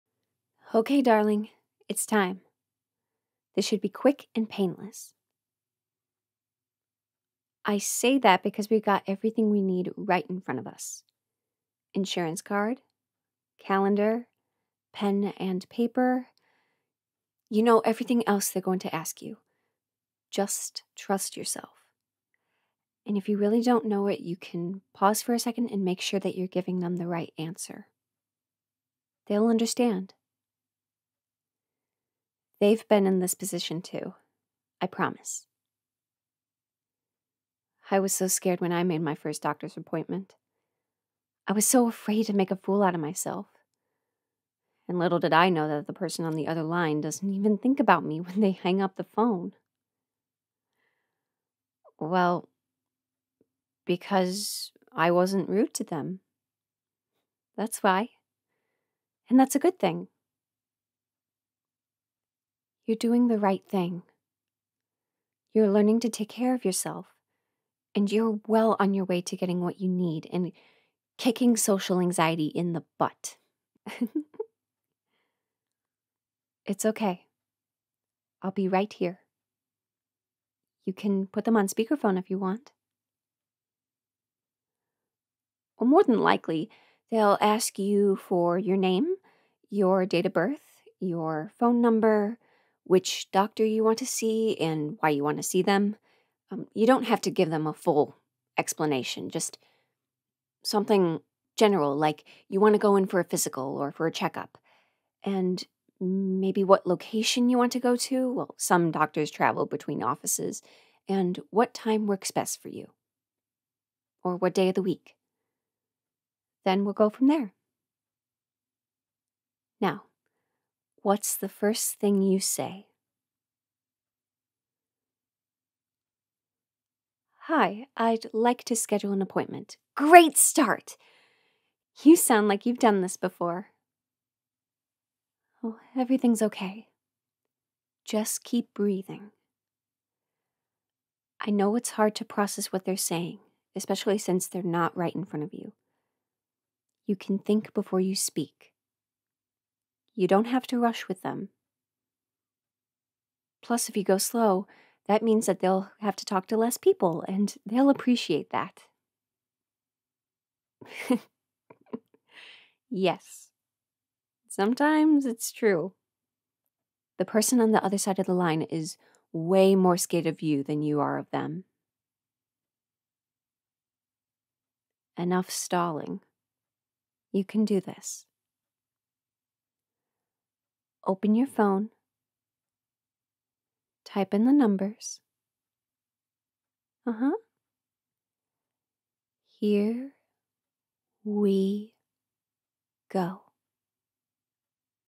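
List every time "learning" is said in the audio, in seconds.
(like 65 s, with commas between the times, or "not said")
65 s.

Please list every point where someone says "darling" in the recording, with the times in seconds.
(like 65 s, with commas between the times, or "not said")
1 s.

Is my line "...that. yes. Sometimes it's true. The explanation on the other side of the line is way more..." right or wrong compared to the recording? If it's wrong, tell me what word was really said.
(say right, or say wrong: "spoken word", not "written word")
wrong: "person", not "explanation".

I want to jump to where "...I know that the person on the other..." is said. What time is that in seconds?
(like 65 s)
45 s.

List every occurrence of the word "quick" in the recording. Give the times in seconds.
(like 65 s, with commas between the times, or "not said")
3 s.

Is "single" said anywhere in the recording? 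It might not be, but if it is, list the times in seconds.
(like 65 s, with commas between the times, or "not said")
not said.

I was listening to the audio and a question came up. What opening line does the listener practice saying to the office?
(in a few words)
I'd like to schedule an appointment.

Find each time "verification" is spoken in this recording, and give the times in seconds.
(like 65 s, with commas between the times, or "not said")
not said.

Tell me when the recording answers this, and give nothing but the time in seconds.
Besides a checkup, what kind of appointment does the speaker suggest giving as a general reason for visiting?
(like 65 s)
103 s.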